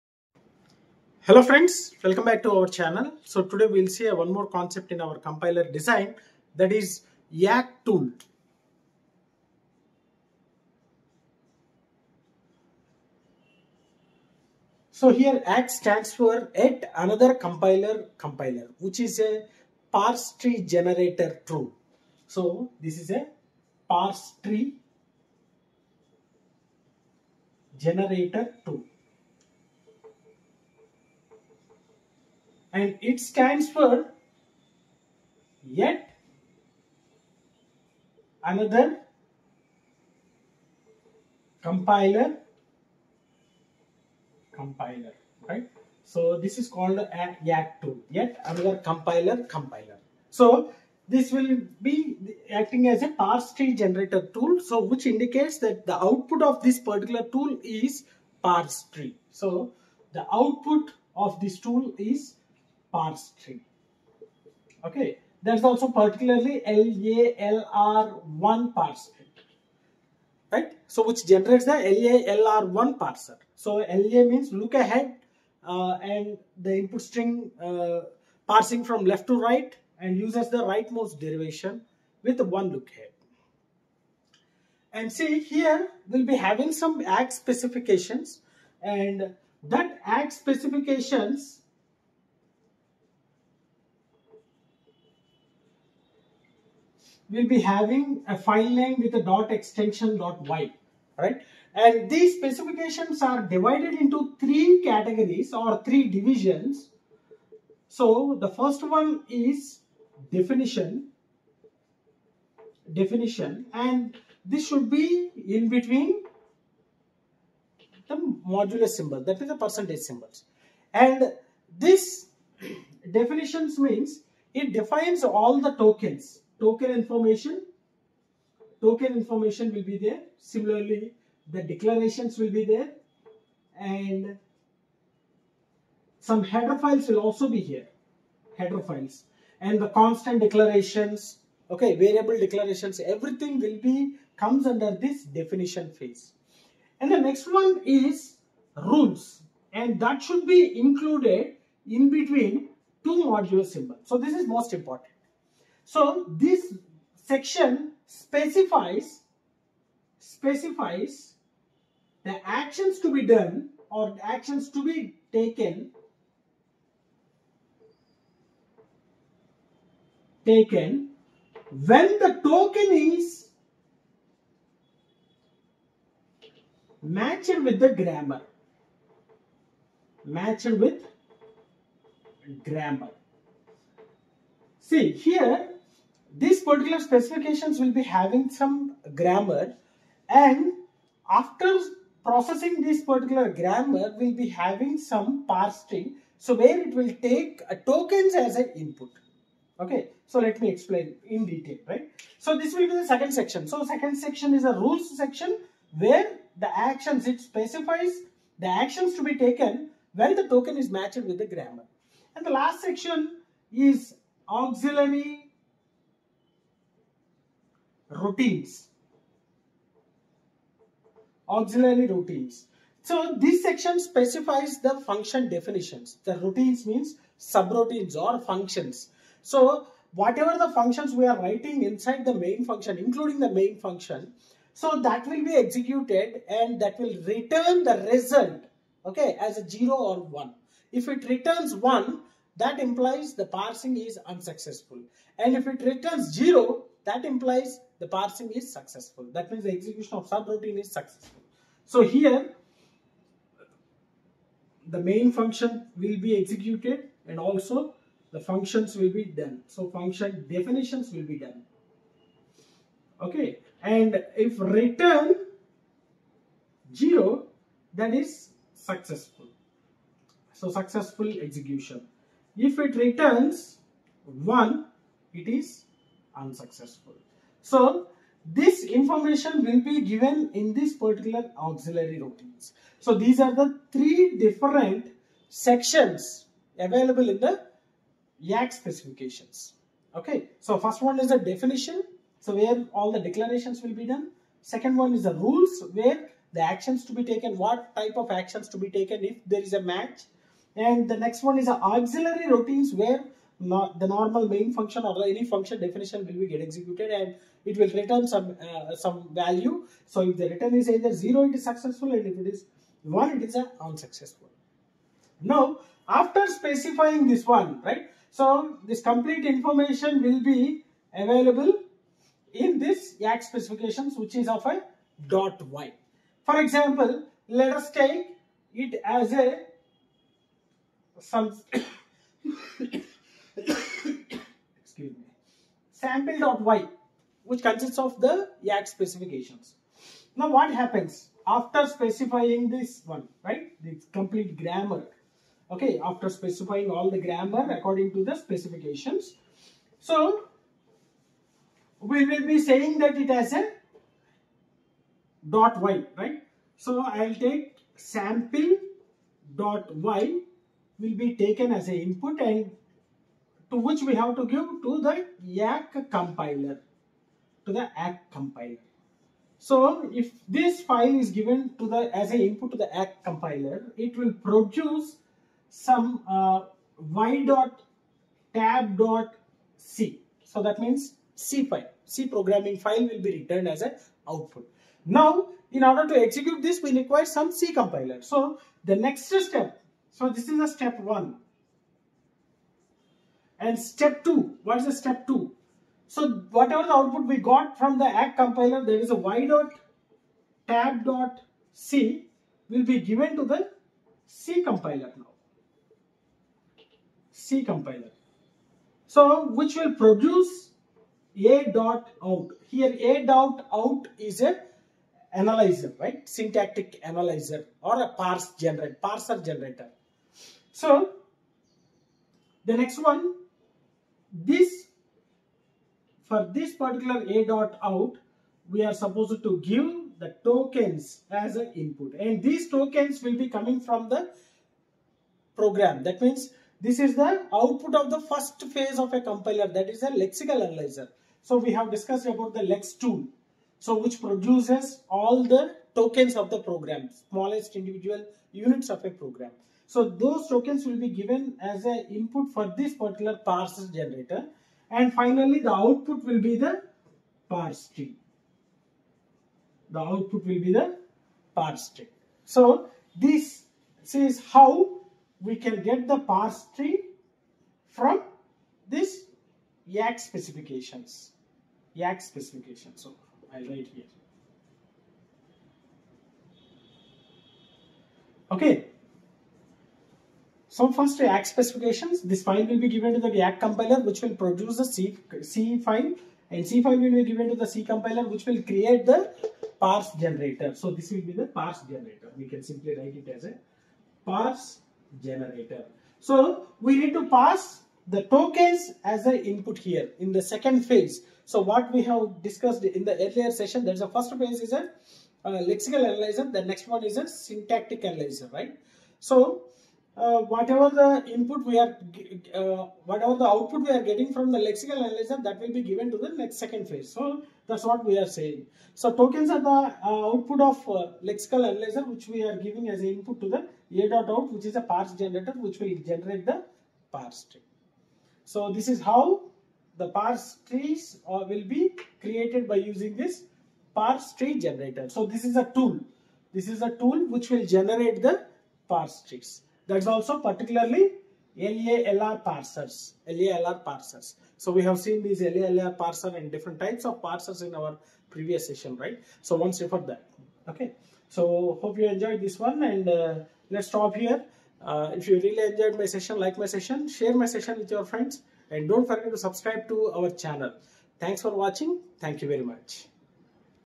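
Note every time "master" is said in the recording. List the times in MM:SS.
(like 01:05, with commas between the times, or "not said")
not said.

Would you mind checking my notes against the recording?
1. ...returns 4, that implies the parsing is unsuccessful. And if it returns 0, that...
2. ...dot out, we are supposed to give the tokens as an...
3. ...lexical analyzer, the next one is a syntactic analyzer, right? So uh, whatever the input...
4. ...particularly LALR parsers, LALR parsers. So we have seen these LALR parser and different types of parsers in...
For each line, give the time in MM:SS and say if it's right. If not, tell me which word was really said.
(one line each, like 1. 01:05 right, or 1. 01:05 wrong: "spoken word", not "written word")
1. 04:01 wrong: "1", not "4"
2. 07:07 right
3. 08:25 right
4. 09:00 right.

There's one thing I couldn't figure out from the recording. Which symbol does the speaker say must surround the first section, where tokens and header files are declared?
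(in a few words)
percentage symbols.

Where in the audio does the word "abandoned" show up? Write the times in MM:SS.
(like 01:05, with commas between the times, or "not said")
not said.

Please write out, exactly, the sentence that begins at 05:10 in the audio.
So if the return is either 0 it is successful and if it is 1 it is an unsuccessful.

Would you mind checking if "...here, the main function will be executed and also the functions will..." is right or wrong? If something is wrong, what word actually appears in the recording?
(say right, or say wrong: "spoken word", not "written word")
right.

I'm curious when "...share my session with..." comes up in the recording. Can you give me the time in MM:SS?
09:17.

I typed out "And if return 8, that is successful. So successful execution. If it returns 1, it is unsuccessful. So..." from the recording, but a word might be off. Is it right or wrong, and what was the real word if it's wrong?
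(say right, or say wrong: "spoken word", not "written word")
wrong: "0", not "8".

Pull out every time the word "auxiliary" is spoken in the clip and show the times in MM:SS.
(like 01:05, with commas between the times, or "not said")
03:34, 03:41, 04:41, 05:01.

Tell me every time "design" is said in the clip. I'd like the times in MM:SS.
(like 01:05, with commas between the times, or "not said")
00:05.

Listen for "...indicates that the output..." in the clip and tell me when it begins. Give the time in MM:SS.
00:55.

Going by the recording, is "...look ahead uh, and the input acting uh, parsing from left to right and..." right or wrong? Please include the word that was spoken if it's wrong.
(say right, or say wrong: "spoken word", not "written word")
wrong: "string", not "acting".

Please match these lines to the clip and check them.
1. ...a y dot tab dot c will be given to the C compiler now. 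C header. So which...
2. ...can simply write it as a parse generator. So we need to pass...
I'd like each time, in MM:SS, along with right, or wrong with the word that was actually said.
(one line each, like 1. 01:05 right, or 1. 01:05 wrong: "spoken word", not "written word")
1. 06:39 wrong: "compiler", not "header"
2. 08:12 right.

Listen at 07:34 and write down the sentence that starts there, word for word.
And finally, the output will be the parse tree.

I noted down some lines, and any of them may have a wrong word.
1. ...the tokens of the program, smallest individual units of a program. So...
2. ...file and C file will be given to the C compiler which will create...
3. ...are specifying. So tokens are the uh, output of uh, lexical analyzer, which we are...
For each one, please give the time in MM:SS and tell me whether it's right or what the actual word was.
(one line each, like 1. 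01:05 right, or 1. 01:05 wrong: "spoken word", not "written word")
1. 07:25 right
2. 08:05 right
3. 08:38 wrong: "saying", not "specifying".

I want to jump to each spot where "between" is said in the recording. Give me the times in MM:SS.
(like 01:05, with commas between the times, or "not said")
01:55, 02:32.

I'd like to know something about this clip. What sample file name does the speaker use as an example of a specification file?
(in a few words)
sample.y.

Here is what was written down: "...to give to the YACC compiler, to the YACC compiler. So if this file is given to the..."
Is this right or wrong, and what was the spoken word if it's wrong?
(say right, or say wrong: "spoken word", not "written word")
right.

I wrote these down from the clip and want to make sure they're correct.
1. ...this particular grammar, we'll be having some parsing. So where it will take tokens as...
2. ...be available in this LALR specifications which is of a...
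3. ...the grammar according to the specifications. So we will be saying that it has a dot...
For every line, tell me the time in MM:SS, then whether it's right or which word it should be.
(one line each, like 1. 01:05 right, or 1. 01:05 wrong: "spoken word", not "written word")
1. 03:12 right
2. 05:20 wrong: "YACC", not "LALR"
3. 05:47 right.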